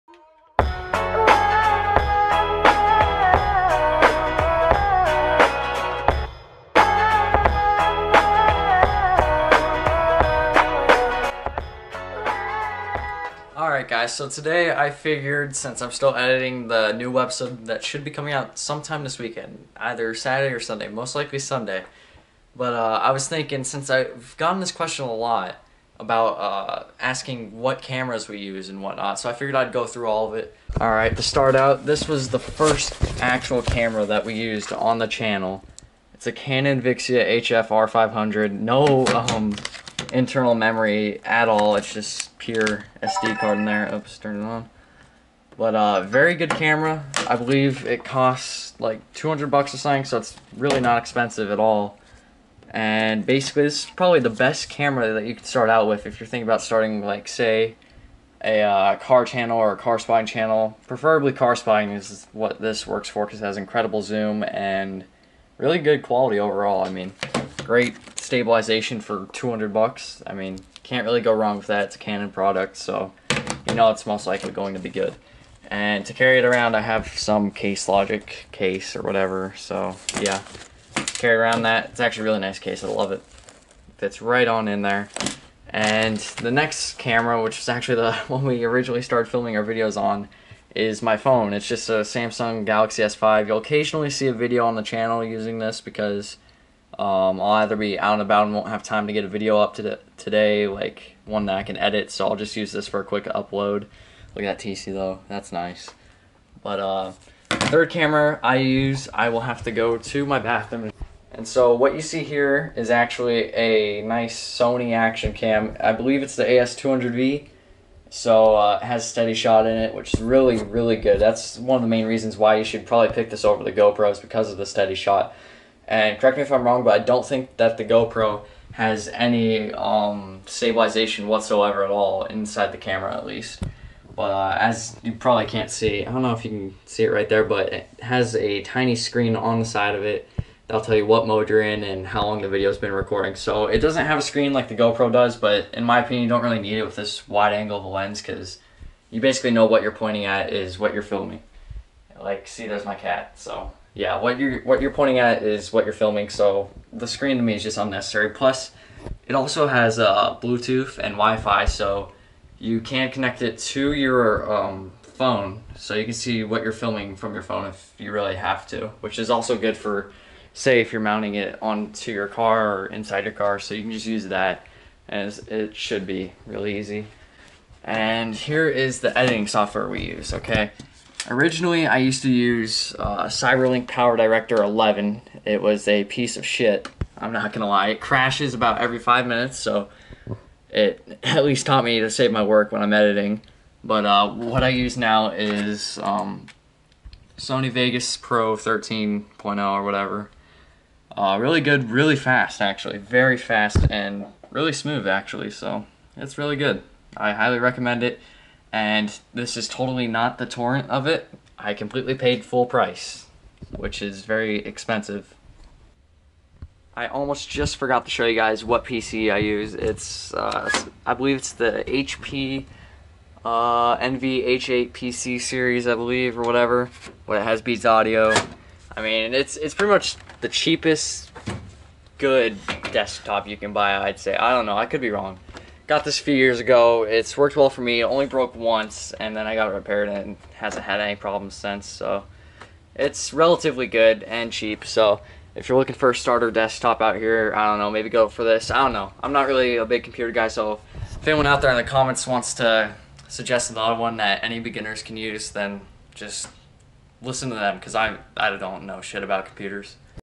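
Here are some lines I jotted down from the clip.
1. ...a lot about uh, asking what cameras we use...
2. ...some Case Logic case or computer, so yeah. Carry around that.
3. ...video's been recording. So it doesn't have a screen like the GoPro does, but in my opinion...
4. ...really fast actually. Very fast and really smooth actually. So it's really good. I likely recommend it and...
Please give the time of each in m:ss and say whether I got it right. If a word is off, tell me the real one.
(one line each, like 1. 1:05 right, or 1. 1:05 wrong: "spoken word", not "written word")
1. 0:25 right
2. 1:17 wrong: "whatever", not "computer"
3. 2:22 right
4. 3:21 wrong: "highly", not "likely".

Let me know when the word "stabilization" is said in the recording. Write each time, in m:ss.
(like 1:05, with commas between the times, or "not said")
1:08, 2:10.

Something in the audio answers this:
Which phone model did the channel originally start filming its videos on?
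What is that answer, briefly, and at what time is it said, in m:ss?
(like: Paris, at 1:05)
Samsung Galaxy S5, at 1:32.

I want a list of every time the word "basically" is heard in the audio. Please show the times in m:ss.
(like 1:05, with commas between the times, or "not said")
0:53, 2:29.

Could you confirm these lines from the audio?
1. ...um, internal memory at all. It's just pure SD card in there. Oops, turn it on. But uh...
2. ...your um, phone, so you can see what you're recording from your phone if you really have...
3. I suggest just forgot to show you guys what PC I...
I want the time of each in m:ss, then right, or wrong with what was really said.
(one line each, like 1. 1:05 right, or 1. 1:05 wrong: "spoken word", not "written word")
1. 0:39 right
2. 2:43 wrong: "filming", not "recording"
3. 3:36 wrong: "almost", not "suggest".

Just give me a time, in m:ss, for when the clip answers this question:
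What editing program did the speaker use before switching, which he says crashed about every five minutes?
3:03.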